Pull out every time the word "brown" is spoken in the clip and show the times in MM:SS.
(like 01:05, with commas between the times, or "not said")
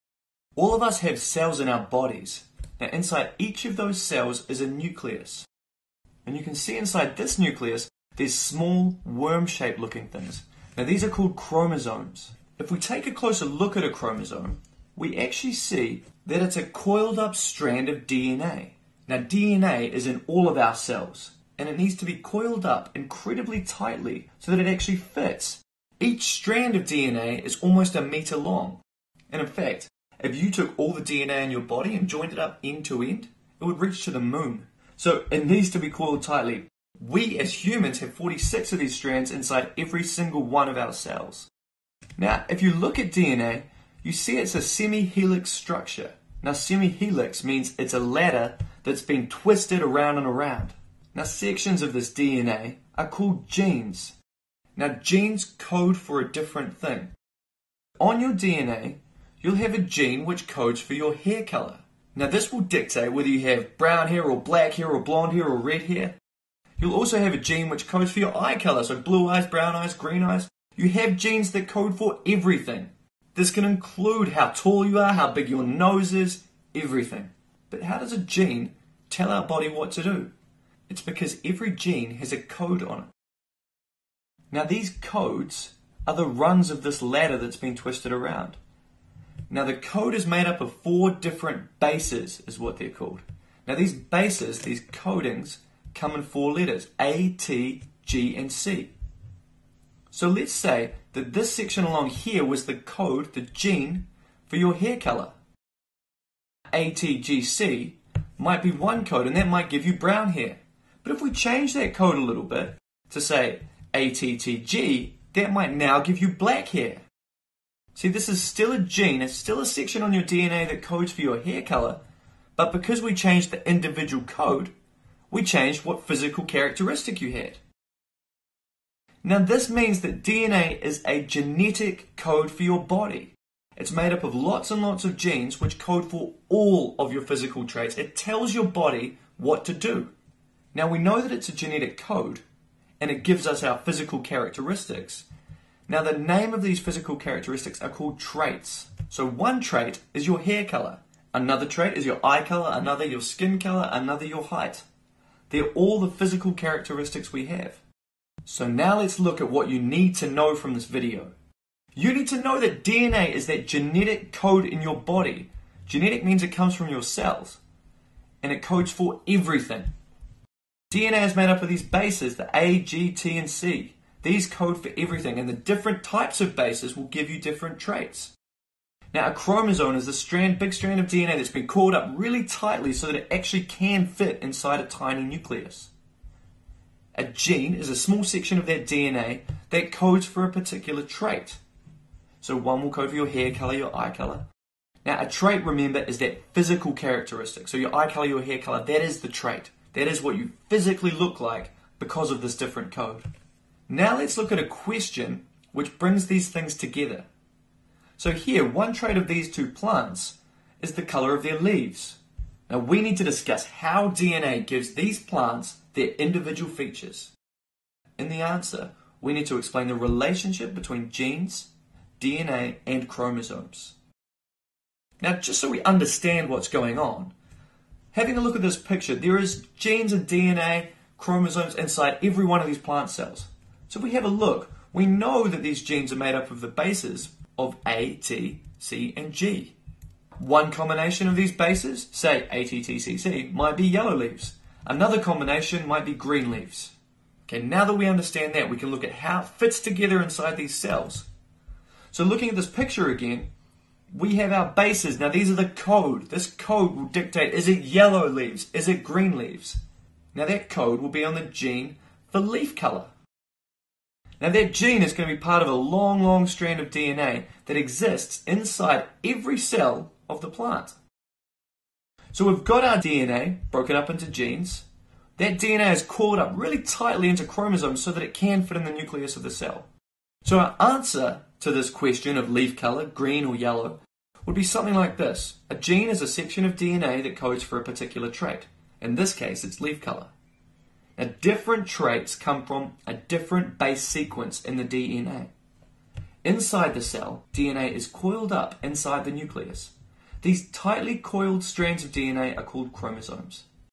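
01:03, 01:09, 01:49.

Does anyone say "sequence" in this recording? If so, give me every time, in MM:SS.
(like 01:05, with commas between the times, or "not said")
04:54.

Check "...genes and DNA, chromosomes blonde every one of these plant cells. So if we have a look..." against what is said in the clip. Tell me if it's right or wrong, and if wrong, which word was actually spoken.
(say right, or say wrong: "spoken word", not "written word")
wrong: "inside", not "blonde".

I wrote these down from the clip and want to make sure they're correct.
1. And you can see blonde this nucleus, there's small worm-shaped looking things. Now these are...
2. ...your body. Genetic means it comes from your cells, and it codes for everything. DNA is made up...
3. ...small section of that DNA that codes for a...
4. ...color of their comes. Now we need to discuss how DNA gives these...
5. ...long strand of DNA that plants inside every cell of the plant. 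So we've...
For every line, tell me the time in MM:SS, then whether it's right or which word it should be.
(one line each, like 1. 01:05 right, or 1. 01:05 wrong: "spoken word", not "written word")
1. 00:06 wrong: "inside", not "blonde"
2. 02:44 right
3. 03:07 right
4. 03:31 wrong: "leaves", not "comes"
5. 04:26 wrong: "exists", not "plants".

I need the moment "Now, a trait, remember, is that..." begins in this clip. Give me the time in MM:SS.
03:15.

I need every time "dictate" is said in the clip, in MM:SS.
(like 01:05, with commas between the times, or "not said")
01:02, 04:17.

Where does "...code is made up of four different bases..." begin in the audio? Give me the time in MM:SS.
01:29.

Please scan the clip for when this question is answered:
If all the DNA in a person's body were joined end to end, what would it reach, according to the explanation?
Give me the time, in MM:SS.
00:33.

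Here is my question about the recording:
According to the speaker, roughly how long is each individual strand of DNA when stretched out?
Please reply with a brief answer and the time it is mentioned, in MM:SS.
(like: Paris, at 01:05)
almost a meter, at 00:27.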